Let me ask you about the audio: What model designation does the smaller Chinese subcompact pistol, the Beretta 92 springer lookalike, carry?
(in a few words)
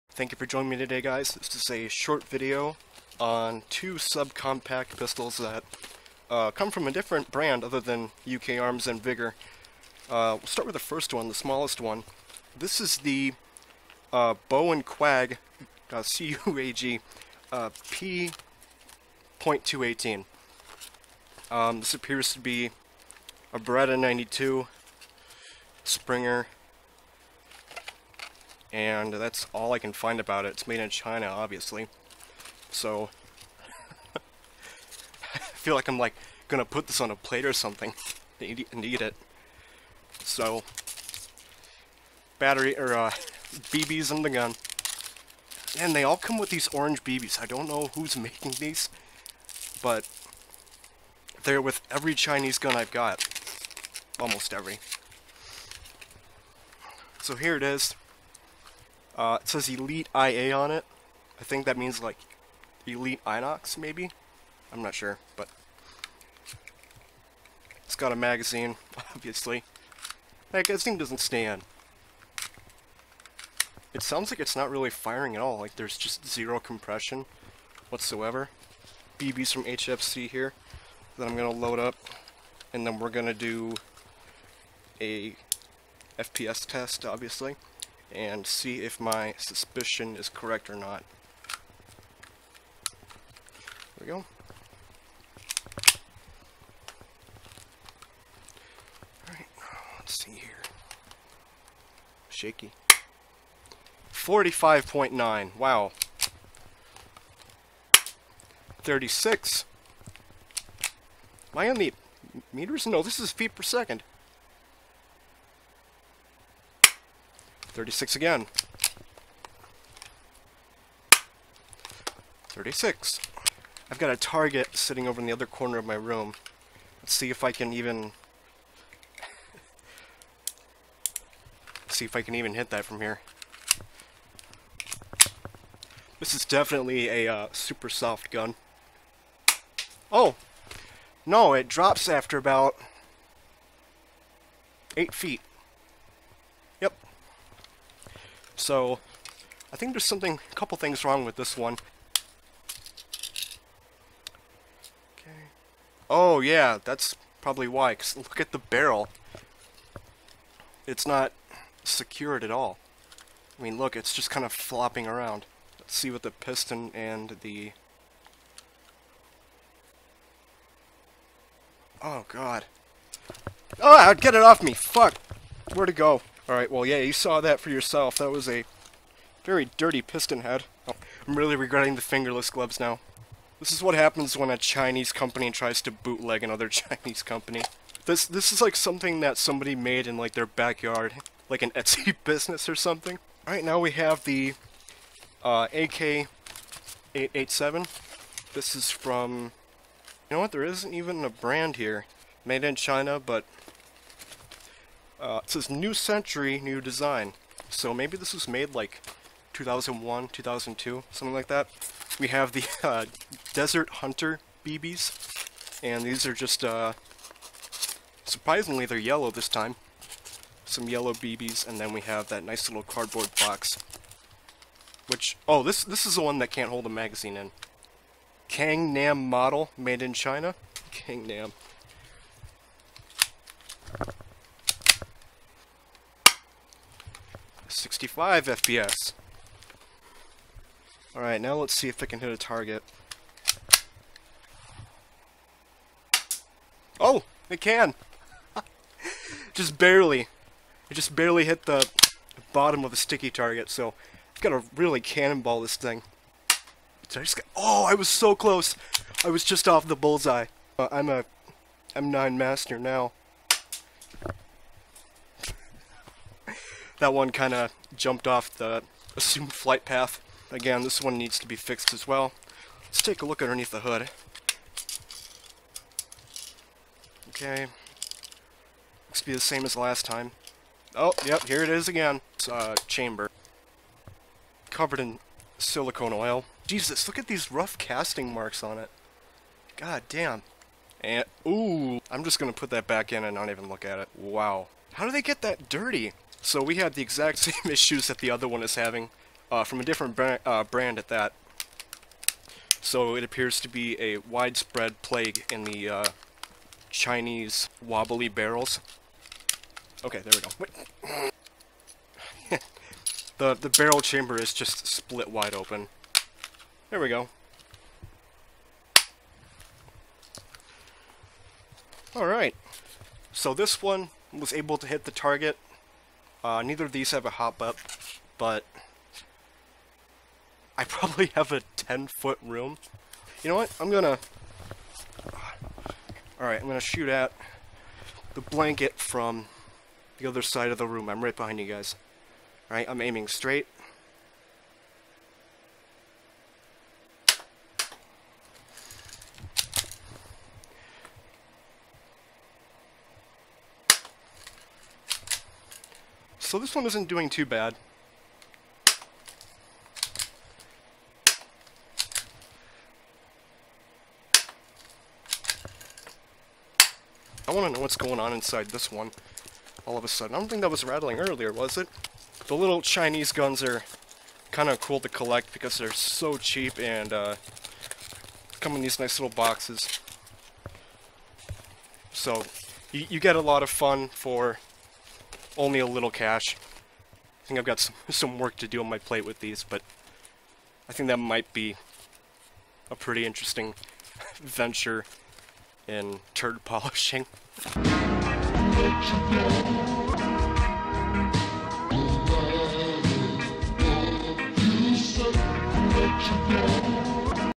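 P.218.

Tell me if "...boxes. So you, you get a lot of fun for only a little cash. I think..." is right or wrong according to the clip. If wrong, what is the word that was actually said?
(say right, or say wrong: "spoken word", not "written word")
right.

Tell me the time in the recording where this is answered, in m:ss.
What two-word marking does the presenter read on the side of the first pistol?
0:59.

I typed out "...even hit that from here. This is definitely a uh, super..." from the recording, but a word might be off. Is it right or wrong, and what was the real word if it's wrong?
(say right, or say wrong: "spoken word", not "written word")
right.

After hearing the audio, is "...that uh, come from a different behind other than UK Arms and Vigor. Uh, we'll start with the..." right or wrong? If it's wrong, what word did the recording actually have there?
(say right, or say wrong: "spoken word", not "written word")
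wrong: "brand", not "behind".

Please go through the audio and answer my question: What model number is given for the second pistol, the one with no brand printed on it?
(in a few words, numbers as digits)
AK-887.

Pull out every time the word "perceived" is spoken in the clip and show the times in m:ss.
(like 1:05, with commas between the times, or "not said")
not said.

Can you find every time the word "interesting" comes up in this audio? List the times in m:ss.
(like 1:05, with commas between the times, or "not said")
6:33.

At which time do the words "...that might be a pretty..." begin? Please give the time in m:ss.
6:31.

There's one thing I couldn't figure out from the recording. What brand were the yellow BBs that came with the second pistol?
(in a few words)
Desert Hunter.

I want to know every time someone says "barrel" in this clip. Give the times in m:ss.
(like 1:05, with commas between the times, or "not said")
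2:38, 5:08, 5:13.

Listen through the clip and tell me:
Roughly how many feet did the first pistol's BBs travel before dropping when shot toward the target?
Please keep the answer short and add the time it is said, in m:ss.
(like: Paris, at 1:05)
8 feet, at 2:24.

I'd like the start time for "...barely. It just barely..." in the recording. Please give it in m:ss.
4:09.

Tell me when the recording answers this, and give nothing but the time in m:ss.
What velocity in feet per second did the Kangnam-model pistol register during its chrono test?
3:57.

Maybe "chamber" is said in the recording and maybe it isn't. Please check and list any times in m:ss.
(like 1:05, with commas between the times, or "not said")
4:42, 5:14.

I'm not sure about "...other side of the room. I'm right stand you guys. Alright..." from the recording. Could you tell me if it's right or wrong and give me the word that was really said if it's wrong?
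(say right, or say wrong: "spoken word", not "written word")
wrong: "behind", not "stand".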